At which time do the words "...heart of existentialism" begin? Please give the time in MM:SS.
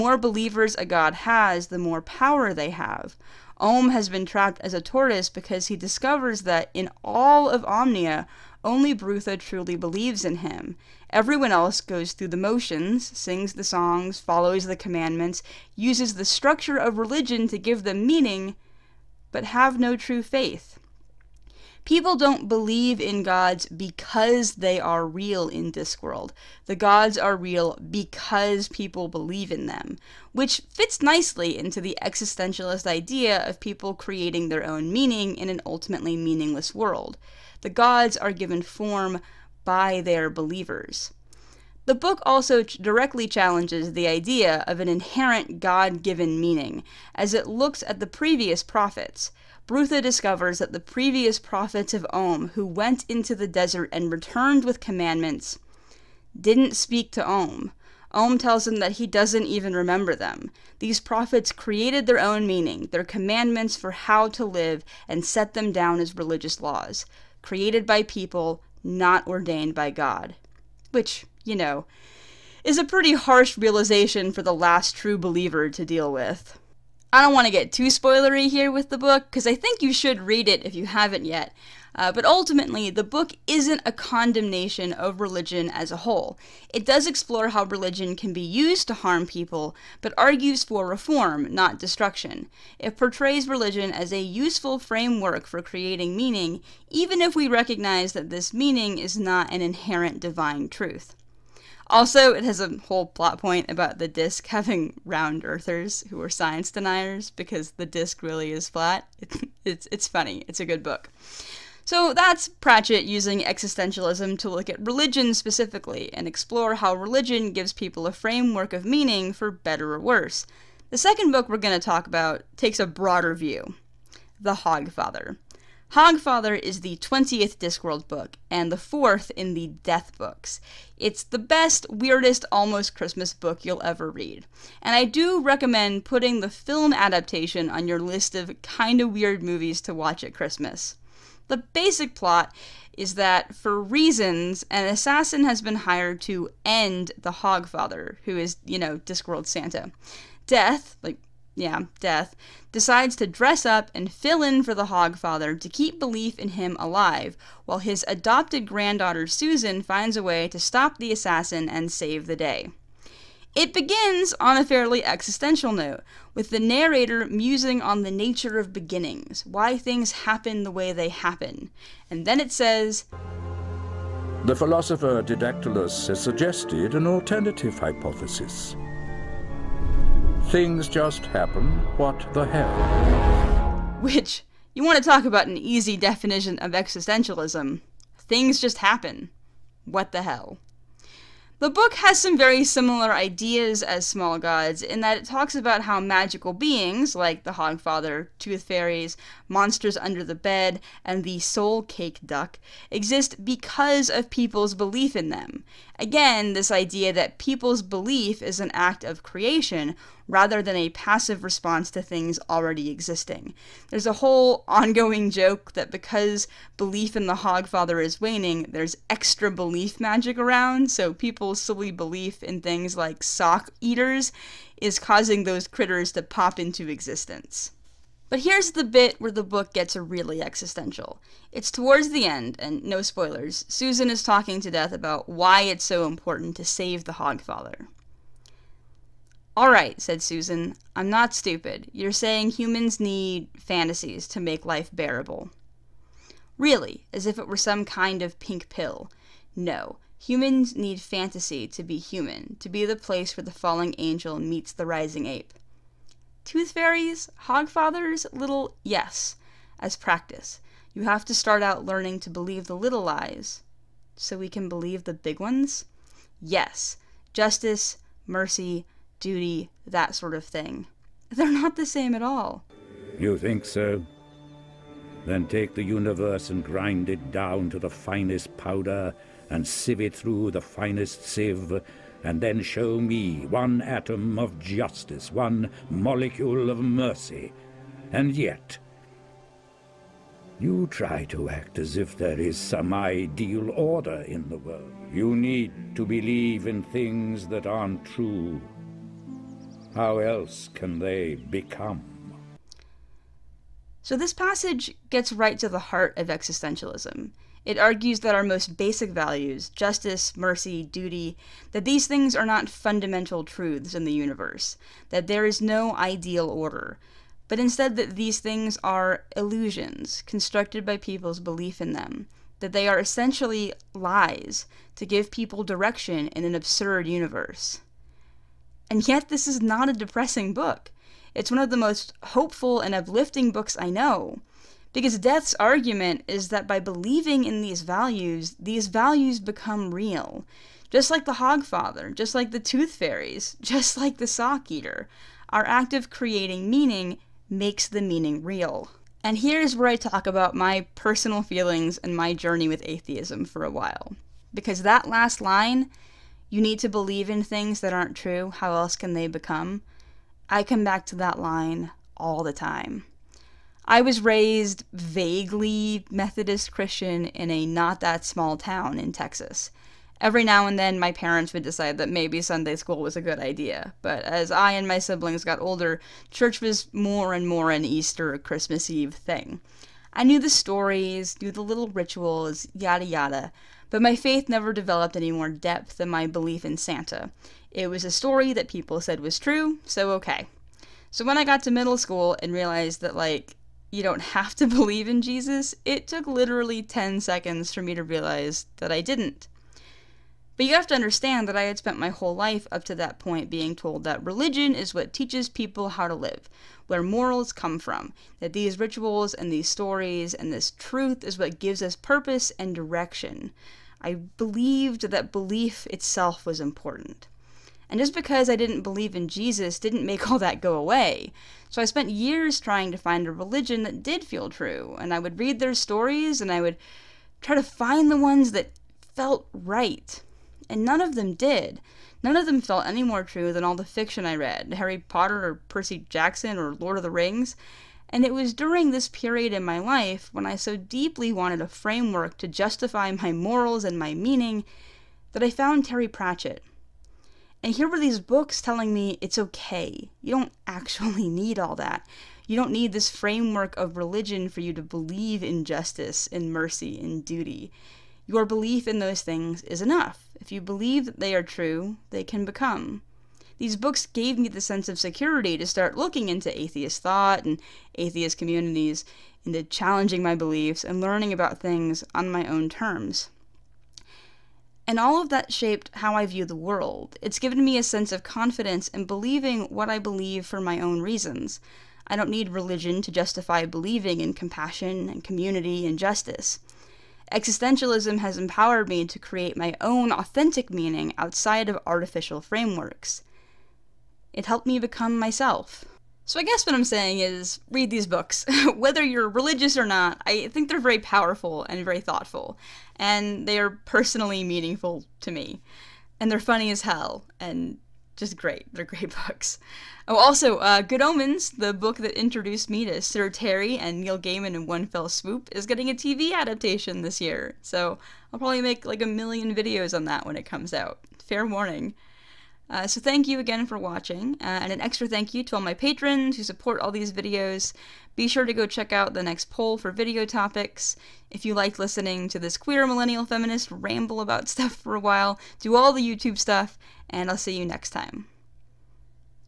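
05:05.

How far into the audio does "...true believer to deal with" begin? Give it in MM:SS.
01:14.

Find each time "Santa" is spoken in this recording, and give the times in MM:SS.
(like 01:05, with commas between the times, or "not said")
02:29, 06:26.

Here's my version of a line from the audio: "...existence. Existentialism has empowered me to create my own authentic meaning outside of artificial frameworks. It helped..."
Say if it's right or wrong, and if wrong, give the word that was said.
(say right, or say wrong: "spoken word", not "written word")
wrong: "justice", not "existence".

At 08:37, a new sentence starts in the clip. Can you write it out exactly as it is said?
So I'll probably make like a million videos on that when it comes out.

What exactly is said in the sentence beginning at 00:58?
Om tells him that he doesn't even remember them.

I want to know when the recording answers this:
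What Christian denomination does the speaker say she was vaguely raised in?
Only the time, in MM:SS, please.
06:06.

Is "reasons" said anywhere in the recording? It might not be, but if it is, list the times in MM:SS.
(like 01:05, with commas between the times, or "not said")
02:23, 08:01.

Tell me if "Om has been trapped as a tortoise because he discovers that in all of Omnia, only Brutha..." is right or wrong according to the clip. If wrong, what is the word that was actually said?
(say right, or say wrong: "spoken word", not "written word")
right.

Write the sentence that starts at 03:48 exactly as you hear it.
But here's the bit where the book gets really existential.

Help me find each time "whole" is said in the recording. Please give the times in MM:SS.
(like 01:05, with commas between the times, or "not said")
01:26, 01:42, 03:34, 06:42.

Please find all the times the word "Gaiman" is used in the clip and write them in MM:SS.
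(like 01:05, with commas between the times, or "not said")
08:34.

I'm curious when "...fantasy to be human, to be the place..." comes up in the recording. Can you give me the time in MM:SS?
04:10.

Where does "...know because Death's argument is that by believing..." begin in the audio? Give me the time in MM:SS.
05:33.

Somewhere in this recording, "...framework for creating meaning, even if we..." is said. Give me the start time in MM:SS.
01:34.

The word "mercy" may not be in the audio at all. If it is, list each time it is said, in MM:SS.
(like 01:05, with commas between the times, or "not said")
04:28, 04:46, 05:10, 07:36.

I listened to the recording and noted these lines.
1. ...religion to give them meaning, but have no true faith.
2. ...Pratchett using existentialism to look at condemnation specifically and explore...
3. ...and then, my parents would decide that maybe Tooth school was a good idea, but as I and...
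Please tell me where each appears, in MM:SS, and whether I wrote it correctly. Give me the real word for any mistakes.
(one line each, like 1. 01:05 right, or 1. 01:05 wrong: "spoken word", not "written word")
1. 00:16 right
2. 01:52 wrong: "religion", not "condemnation"
3. 06:10 wrong: "Sunday", not "Tooth".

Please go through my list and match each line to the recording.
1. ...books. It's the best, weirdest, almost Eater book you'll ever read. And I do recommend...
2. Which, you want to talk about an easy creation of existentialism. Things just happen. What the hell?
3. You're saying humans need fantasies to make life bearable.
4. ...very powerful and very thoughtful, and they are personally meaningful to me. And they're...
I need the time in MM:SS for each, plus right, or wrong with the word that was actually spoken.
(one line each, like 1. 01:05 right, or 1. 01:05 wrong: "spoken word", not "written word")
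1. 02:10 wrong: "Christmas", not "Eater"
2. 03:04 wrong: "definition", not "creation"
3. 04:01 right
4. 08:20 right.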